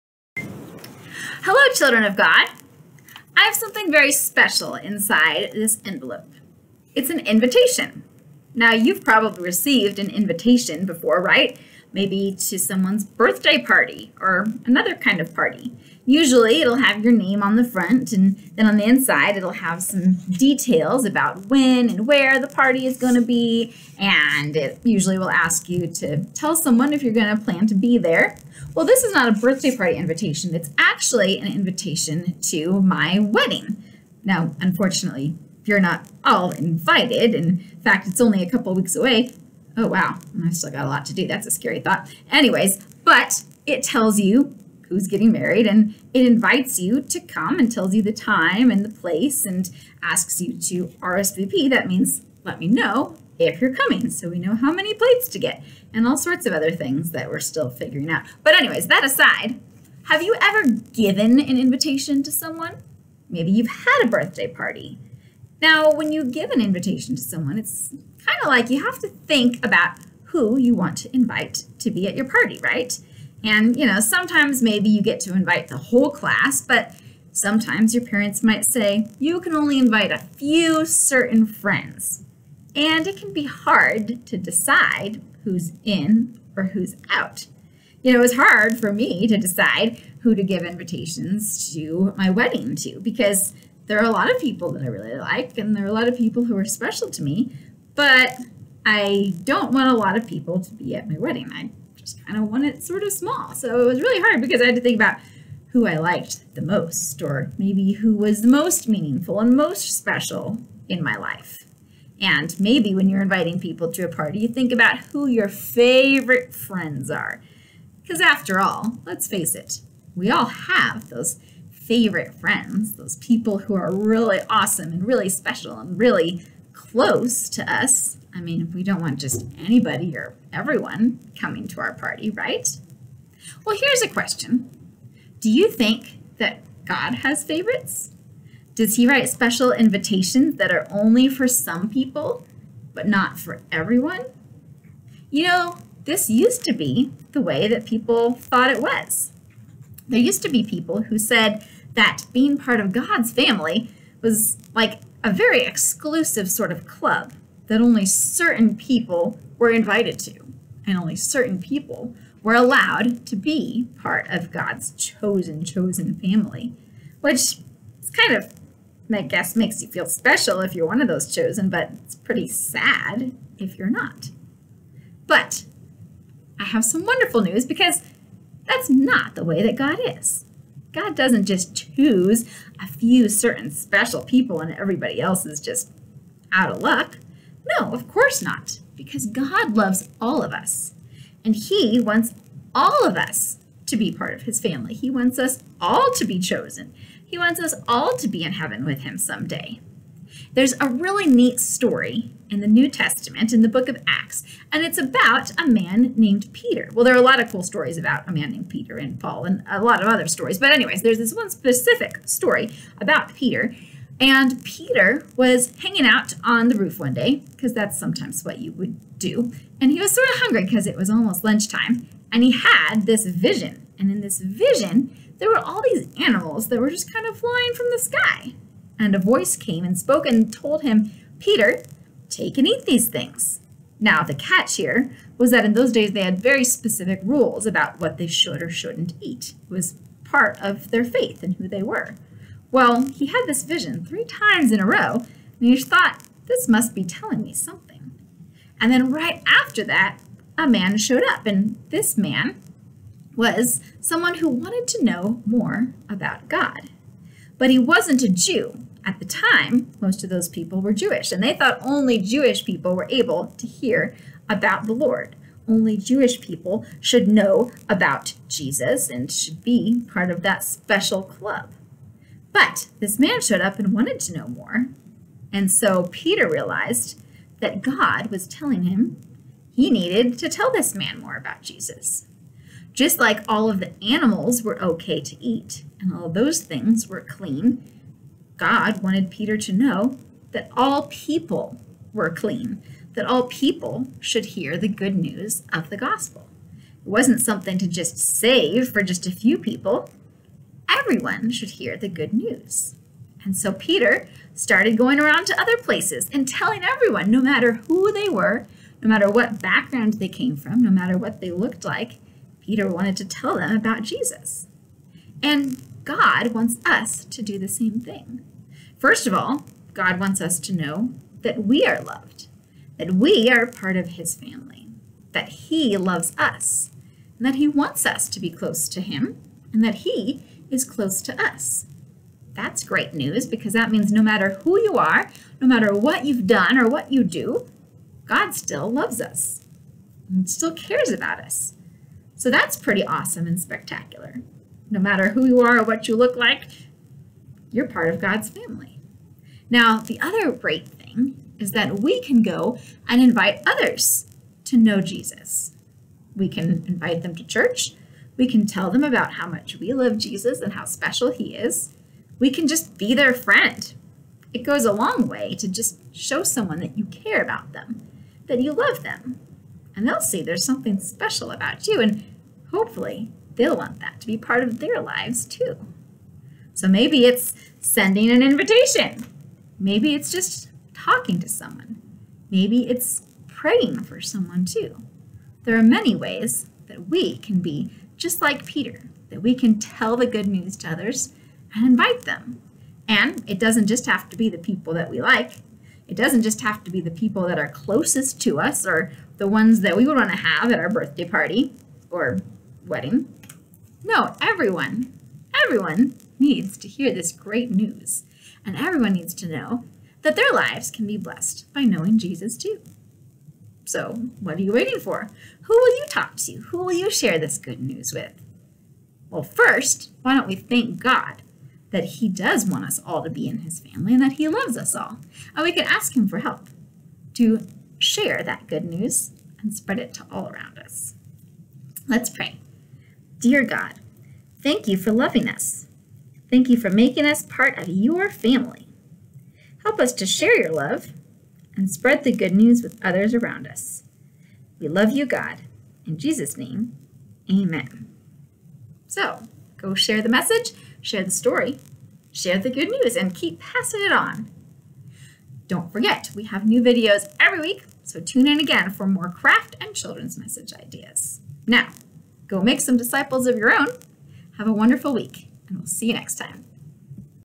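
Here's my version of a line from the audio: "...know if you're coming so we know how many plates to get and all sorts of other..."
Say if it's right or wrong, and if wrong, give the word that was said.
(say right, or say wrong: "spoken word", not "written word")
right.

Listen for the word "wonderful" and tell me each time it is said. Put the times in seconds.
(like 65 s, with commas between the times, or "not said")
177 s, 464 s.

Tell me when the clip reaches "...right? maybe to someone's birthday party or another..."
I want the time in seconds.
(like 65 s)
11 s.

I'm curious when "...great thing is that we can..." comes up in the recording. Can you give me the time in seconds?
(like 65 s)
350 s.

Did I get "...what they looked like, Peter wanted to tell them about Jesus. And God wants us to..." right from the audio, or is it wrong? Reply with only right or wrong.
right.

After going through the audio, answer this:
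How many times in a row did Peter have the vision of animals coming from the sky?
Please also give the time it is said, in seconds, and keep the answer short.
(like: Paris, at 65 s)
3, at 244 s.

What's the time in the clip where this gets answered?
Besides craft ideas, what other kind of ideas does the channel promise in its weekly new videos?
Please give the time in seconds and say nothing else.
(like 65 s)
459 s.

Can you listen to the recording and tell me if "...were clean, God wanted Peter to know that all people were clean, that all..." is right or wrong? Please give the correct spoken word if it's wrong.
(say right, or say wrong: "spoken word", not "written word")
right.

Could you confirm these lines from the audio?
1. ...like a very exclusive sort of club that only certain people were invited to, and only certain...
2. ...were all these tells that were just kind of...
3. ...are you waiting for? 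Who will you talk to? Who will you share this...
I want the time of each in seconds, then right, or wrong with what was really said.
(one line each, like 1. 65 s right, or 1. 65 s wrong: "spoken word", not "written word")
1. 154 s right
2. 225 s wrong: "animals", not "tells"
3. 414 s right.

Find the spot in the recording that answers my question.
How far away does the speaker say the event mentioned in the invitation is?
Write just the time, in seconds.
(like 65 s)
38 s.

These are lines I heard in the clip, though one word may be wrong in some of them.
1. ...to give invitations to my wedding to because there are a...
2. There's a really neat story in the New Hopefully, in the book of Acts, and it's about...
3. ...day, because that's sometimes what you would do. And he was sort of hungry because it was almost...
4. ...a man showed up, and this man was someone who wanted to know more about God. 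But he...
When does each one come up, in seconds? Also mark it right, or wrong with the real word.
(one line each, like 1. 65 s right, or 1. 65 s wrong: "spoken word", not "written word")
1. 90 s right
2. 200 s wrong: "Testament", not "Hopefully"
3. 217 s right
4. 250 s right.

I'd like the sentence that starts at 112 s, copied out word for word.
And maybe when you're inviting people to a party, you think about who your favorite friends are.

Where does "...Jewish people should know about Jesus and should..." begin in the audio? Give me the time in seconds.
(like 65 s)
265 s.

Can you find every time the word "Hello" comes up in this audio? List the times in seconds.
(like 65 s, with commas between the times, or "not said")
1 s.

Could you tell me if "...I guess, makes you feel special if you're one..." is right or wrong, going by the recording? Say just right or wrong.
right.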